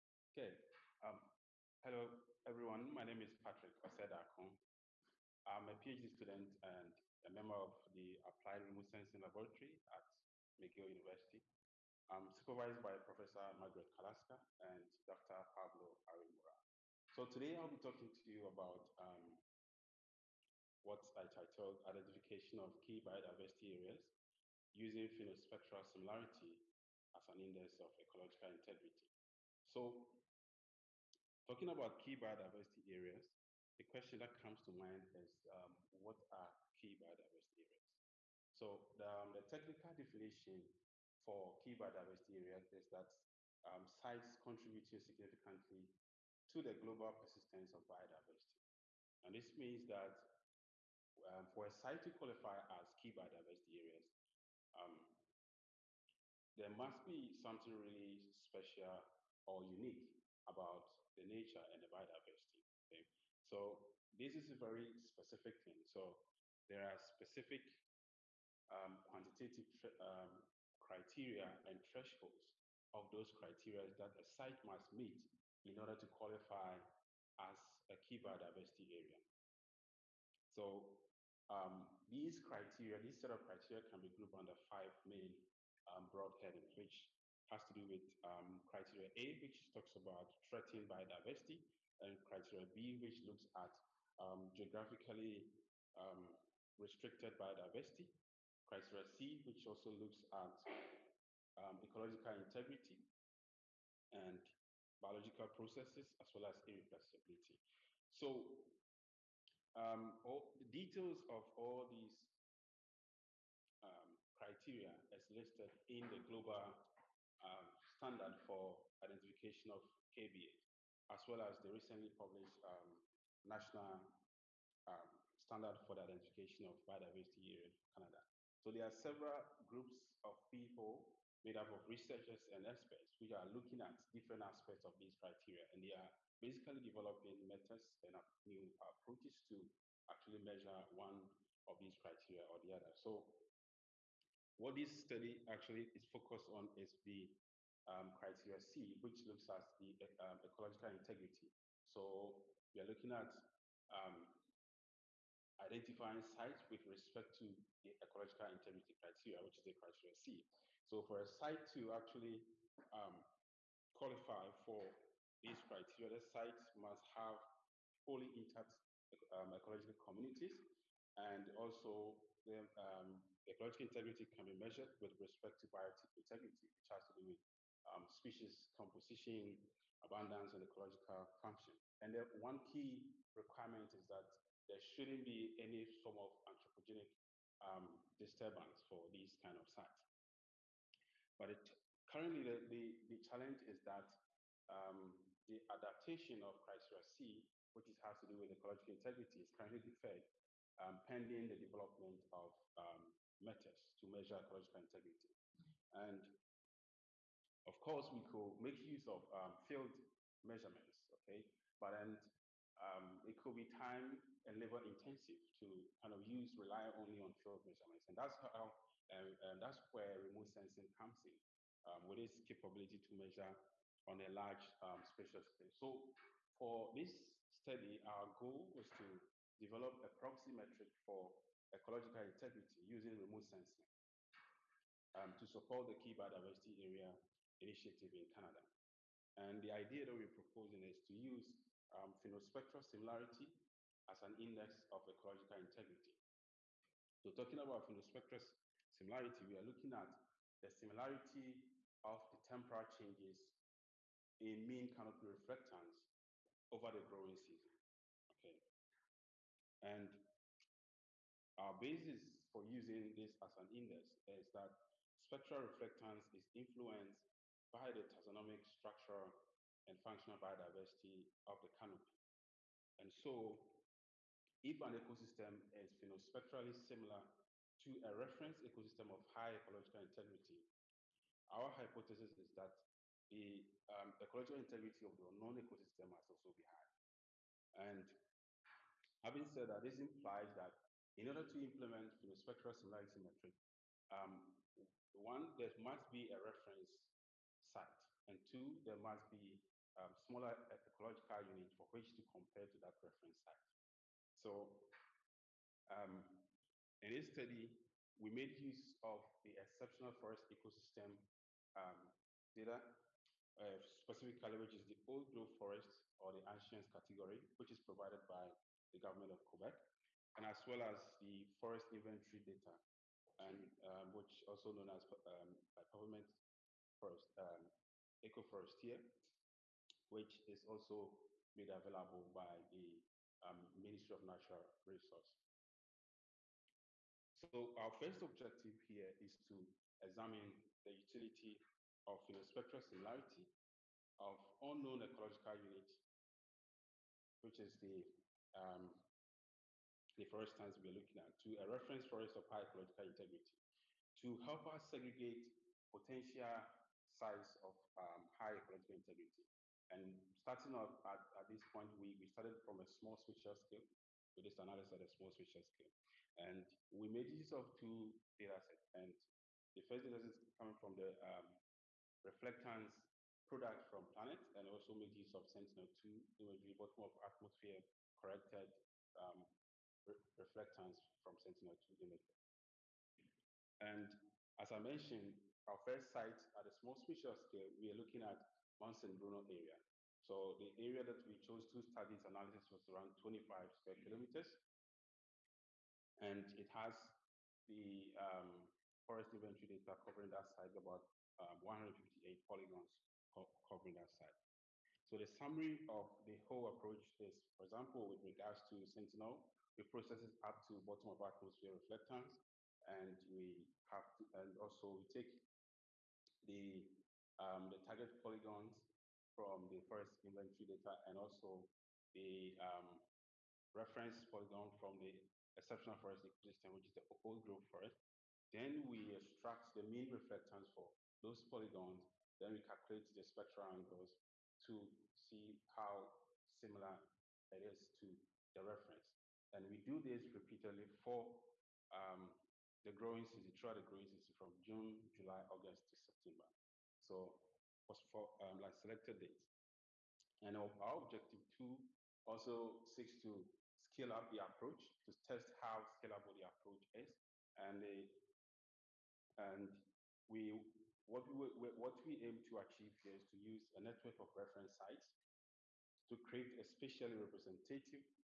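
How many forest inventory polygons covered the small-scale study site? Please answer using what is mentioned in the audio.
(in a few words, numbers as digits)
158.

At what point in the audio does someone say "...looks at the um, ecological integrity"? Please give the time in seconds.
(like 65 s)
149 s.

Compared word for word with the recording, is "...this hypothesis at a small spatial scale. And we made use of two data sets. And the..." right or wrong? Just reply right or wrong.
wrong.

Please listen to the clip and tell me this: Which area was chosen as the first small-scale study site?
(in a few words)
Mount Bruno.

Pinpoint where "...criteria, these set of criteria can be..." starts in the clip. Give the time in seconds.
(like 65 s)
82 s.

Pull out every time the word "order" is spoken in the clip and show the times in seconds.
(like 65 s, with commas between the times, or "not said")
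75 s, 291 s.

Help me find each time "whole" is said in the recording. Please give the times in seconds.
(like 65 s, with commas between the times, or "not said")
406 s.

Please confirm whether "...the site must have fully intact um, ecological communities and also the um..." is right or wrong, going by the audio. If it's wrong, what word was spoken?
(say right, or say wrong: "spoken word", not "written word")
right.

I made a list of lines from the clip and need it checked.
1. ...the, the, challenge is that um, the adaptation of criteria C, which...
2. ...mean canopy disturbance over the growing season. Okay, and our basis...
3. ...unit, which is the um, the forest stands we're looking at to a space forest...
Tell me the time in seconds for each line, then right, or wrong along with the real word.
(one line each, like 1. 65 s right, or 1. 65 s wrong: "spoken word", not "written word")
1. 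192 s right
2. 254 s wrong: "reflectance", not "disturbance"
3. 345 s wrong: "reference", not "space".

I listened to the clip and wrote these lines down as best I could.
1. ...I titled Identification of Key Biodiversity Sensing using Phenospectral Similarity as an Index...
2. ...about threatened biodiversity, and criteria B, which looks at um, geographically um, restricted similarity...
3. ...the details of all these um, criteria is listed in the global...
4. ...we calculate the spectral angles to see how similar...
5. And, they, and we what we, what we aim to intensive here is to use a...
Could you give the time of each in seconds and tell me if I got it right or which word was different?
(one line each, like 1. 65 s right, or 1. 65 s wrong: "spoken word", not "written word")
1. 21 s wrong: "Areas", not "Sensing"
2. 89 s wrong: "biodiversity", not "similarity"
3. 110 s right
4. 432 s right
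5. 457 s wrong: "achieve", not "intensive".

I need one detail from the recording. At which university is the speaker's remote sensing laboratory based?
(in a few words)
McGill University.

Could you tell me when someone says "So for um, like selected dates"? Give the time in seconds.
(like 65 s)
447 s.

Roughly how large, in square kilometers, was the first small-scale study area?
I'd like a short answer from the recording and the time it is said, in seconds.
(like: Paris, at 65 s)
25, at 393 s.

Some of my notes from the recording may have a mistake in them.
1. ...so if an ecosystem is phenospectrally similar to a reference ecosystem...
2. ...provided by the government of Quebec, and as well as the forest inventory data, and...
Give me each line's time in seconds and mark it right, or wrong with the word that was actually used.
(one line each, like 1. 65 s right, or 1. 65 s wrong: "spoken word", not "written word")
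1. 273 s right
2. 317 s right.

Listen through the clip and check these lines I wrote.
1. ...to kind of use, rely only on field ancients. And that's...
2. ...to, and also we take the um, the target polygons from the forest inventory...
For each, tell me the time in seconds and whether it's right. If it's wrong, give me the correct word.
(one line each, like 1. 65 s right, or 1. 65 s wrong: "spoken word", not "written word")
1. 215 s wrong: "measurements", not "ancients"
2. 414 s right.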